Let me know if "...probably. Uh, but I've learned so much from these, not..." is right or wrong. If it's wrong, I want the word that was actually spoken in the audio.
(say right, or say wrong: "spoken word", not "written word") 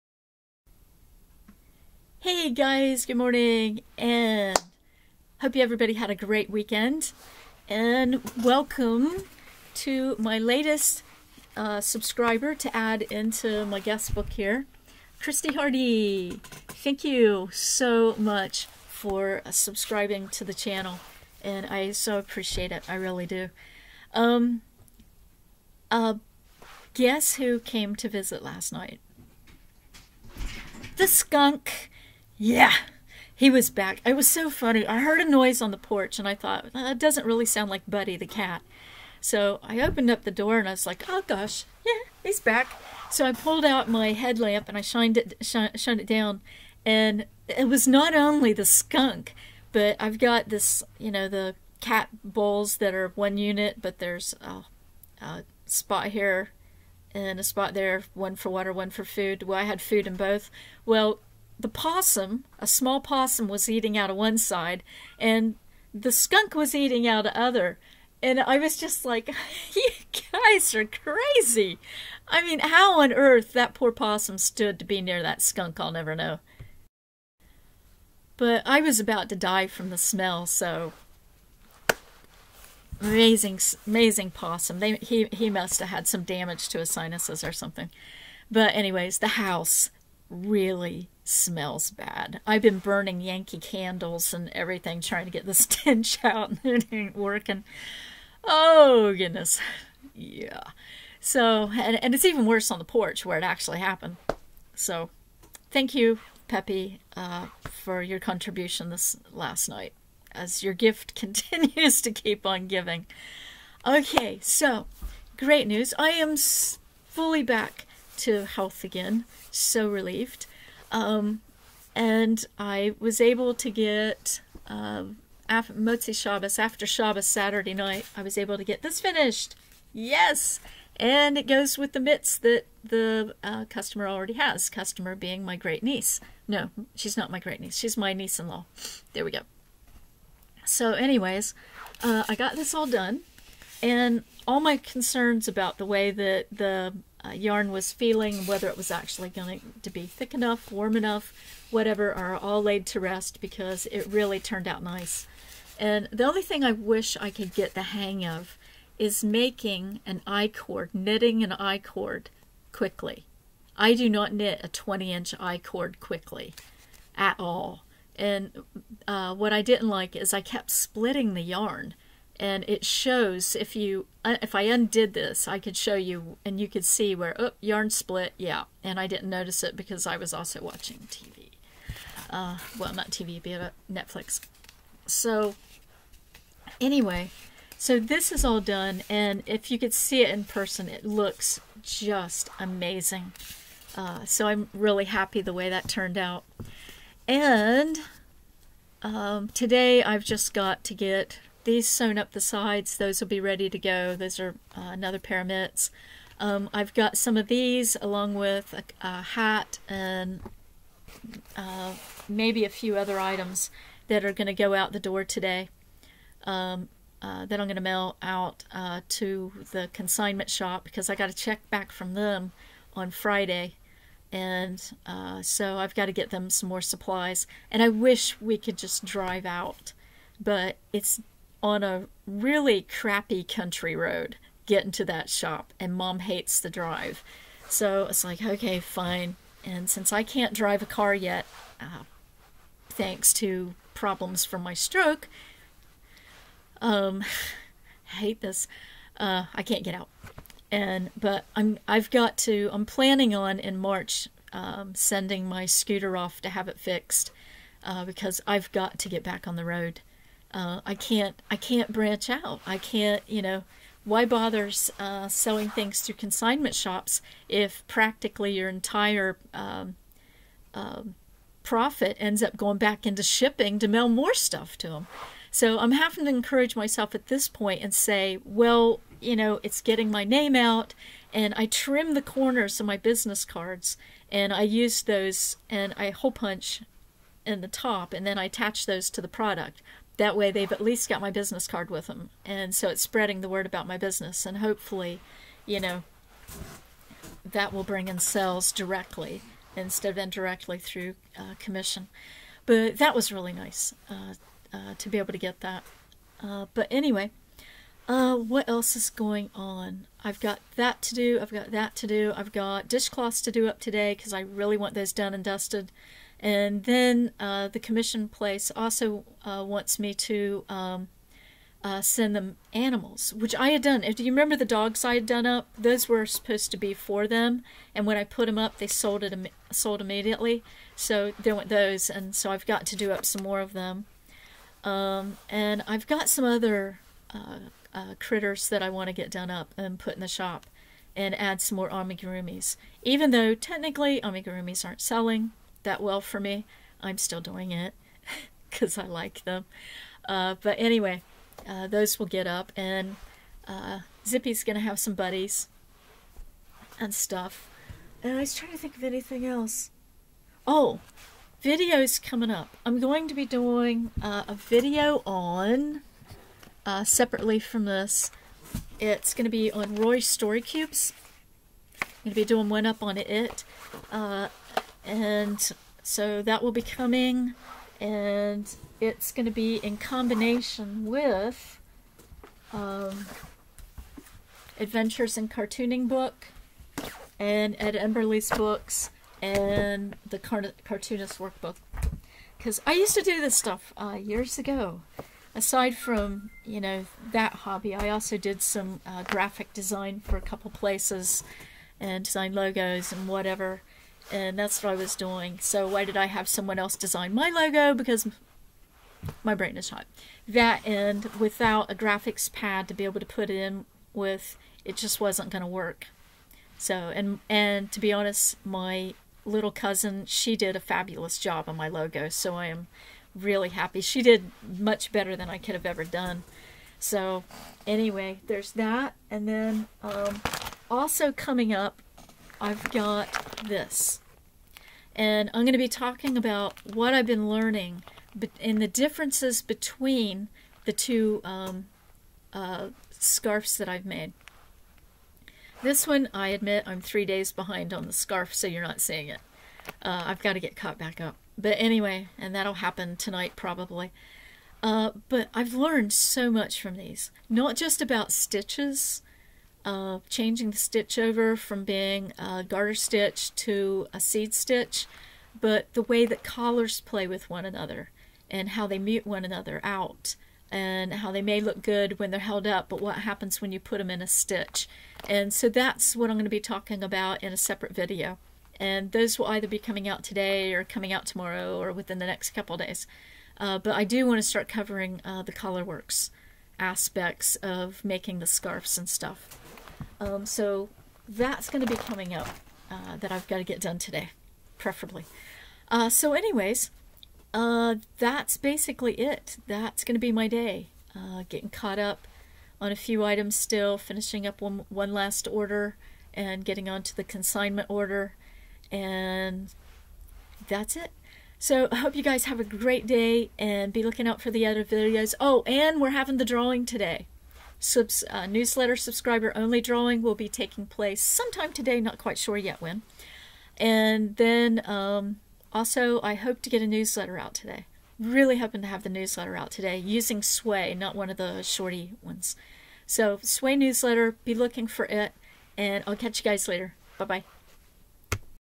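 right.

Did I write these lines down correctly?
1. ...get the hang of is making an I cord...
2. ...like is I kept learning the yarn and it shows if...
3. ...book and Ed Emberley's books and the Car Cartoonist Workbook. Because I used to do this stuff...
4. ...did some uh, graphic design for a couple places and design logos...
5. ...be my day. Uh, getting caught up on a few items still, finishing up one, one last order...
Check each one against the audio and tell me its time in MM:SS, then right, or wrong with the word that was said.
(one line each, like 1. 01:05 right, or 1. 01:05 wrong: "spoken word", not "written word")
1. 02:37 right
2. 02:49 wrong: "splitting", not "learning"
3. 06:26 right
4. 06:38 right
5. 08:20 right.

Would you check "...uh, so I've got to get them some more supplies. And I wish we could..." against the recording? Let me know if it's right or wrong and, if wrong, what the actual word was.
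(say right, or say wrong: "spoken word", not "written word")
right.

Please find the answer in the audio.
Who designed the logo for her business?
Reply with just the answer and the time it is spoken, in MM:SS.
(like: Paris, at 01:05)
little cousin, at 06:58.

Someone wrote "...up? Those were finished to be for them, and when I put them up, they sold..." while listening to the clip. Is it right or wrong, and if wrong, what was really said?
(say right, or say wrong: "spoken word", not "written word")
wrong: "supposed", not "finished".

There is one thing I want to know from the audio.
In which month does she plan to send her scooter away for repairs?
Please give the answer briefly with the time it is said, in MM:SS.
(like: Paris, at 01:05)
March, at 04:13.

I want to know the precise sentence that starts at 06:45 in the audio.
So why did I have someone else design my logo?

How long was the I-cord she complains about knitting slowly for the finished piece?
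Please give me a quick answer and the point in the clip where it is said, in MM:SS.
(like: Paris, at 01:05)
20 inches, at 02:44.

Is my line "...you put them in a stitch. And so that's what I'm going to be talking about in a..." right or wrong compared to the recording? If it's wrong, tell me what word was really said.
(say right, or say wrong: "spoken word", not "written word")
right.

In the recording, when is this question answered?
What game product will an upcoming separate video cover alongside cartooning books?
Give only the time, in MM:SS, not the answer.
06:09.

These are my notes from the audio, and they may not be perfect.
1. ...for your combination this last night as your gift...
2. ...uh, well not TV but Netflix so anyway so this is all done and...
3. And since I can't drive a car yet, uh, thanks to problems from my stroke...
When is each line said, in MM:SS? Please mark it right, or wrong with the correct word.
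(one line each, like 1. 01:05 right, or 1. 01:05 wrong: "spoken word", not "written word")
1. 01:47 wrong: "contribution", not "combination"
2. 03:02 right
3. 03:59 right.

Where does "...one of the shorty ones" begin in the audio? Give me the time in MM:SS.
08:51.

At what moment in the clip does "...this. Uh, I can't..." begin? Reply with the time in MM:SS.
04:08.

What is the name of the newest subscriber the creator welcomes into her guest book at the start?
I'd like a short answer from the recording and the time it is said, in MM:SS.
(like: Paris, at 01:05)
Christy Hardy, at 00:15.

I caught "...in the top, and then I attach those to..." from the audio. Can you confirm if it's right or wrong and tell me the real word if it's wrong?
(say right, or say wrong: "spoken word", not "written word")
right.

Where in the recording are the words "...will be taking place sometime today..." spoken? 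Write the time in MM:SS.
08:40.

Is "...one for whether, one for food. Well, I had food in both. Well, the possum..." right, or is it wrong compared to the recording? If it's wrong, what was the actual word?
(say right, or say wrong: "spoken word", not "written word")
wrong: "water", not "whether".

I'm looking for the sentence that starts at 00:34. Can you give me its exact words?
I heard a noise on the porch and I thought, that doesn't really sound like Buddy the cat.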